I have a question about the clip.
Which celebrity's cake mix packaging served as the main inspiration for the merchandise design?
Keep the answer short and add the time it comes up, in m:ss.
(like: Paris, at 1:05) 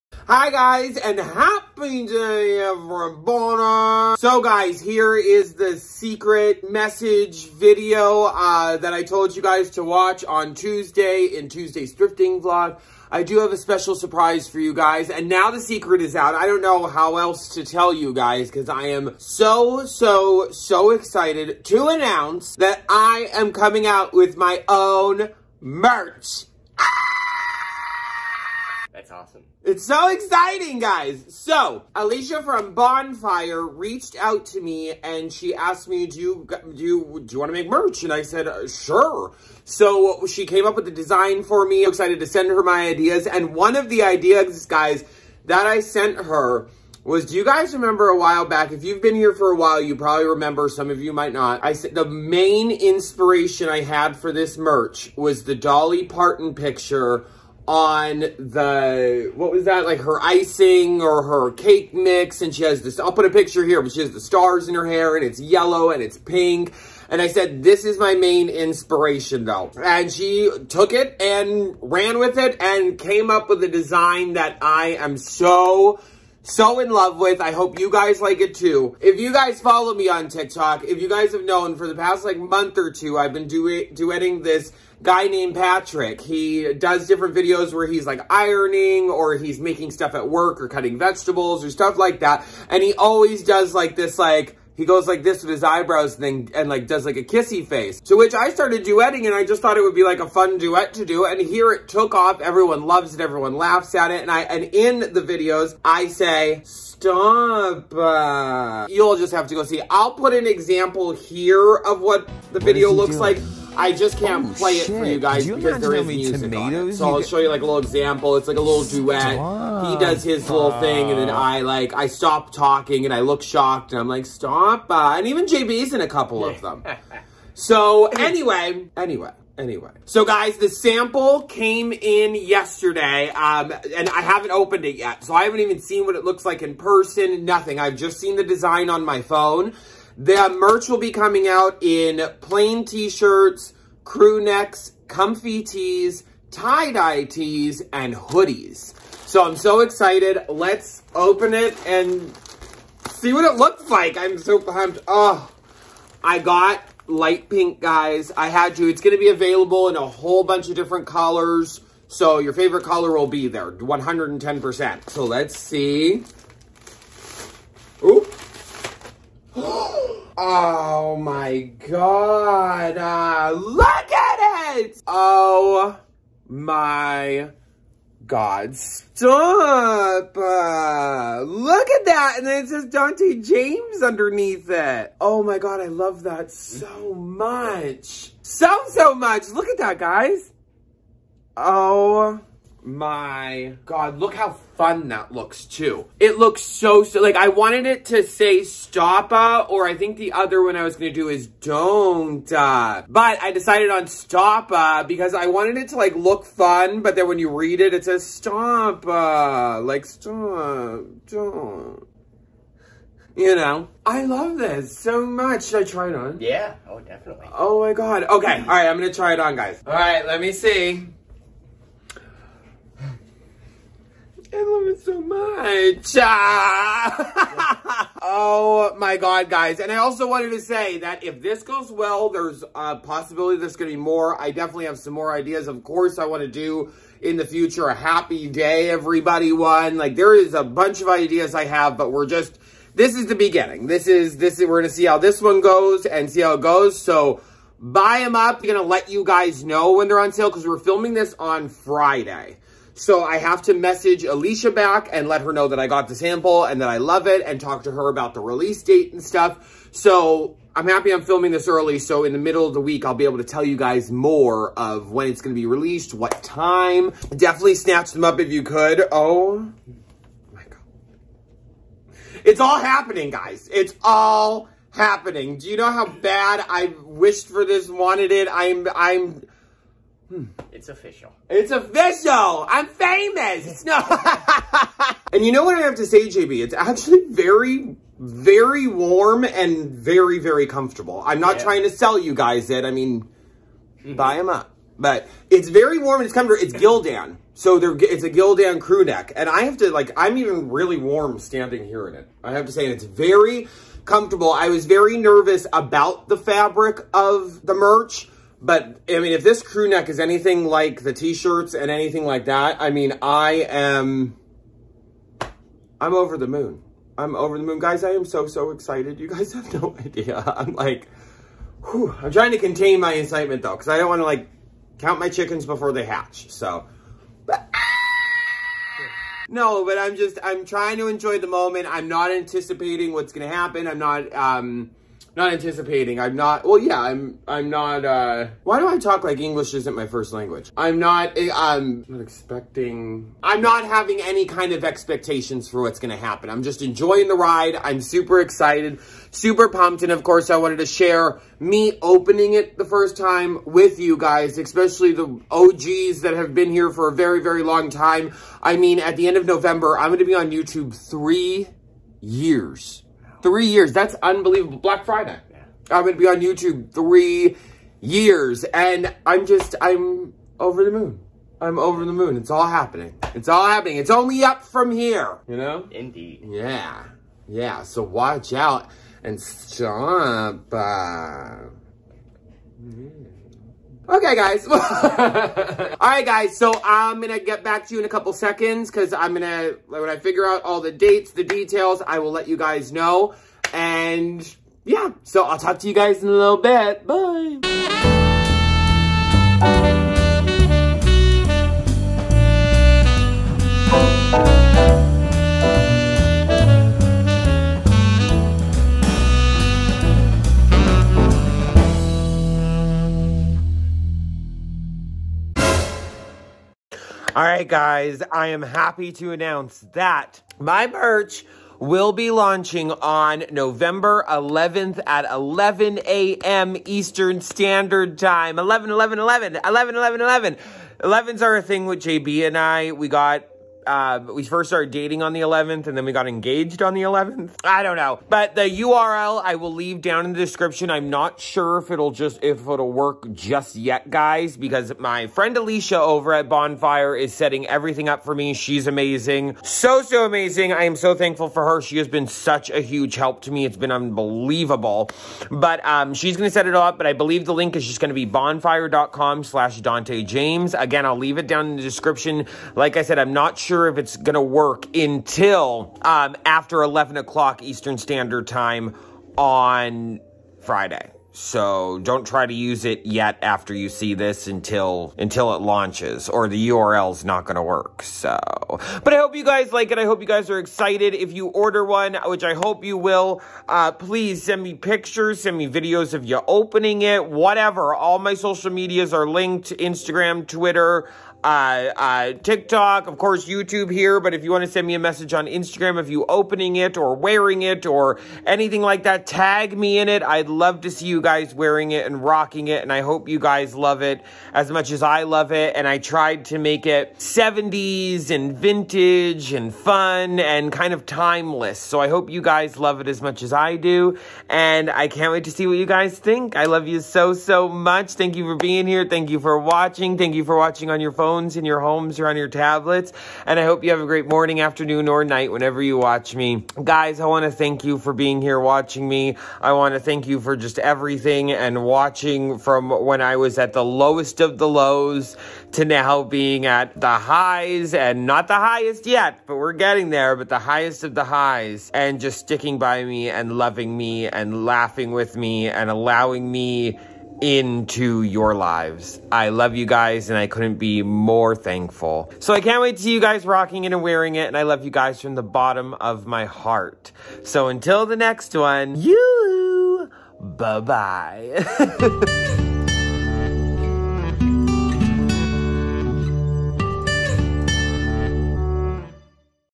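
Dolly Parton, at 0:55.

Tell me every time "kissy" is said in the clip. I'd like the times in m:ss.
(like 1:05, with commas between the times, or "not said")
1:37.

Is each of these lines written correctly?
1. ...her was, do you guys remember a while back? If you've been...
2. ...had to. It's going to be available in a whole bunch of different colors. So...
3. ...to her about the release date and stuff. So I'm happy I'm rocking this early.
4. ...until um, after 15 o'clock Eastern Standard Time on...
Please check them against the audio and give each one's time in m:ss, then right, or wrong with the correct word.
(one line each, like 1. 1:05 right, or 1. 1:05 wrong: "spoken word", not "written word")
1. 0:46 right
2. 2:38 right
3. 4:17 wrong: "filming", not "rocking"
4. 7:44 wrong: "11", not "15".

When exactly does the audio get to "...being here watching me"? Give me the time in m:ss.
8:48.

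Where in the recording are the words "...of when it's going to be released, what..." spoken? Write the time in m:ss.
4:24.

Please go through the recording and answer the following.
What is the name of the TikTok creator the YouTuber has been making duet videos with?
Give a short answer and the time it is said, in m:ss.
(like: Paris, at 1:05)
Patrick, at 1:25.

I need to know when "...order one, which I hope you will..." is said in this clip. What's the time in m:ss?
8:01.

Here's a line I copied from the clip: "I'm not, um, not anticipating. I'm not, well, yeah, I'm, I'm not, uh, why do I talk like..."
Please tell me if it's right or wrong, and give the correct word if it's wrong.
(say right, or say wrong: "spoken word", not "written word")
right.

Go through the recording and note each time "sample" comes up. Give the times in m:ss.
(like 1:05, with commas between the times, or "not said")
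2:10, 4:16.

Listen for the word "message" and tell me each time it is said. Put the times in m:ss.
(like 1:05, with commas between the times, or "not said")
0:06, 4:13, 8:14.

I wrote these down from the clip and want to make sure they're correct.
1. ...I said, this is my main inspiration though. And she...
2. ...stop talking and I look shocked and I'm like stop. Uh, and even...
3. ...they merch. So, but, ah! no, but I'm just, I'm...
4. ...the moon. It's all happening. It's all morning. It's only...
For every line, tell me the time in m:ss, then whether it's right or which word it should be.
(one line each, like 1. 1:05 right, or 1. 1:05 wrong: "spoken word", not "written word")
1. 1:07 right
2. 2:02 right
3. 5:25 wrong: "hatch", not "merch"
4. 6:12 wrong: "happening", not "morning".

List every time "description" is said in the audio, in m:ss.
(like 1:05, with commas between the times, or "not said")
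7:20, 7:41.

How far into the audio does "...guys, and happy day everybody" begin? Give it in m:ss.
0:00.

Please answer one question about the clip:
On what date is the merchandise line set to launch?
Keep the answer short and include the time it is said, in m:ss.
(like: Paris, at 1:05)
November 11th, at 7:03.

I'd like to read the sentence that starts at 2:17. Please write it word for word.
I've just seen the design on my phone.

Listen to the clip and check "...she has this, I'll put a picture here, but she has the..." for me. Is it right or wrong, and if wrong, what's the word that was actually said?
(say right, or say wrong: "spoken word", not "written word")
right.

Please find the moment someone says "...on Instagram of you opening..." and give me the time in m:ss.
8:15.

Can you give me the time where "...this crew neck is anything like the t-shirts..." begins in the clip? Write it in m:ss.
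5:09.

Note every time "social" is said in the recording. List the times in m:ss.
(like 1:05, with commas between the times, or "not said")
8:08.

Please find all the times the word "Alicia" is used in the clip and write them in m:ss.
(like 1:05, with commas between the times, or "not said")
0:31, 4:14, 7:25.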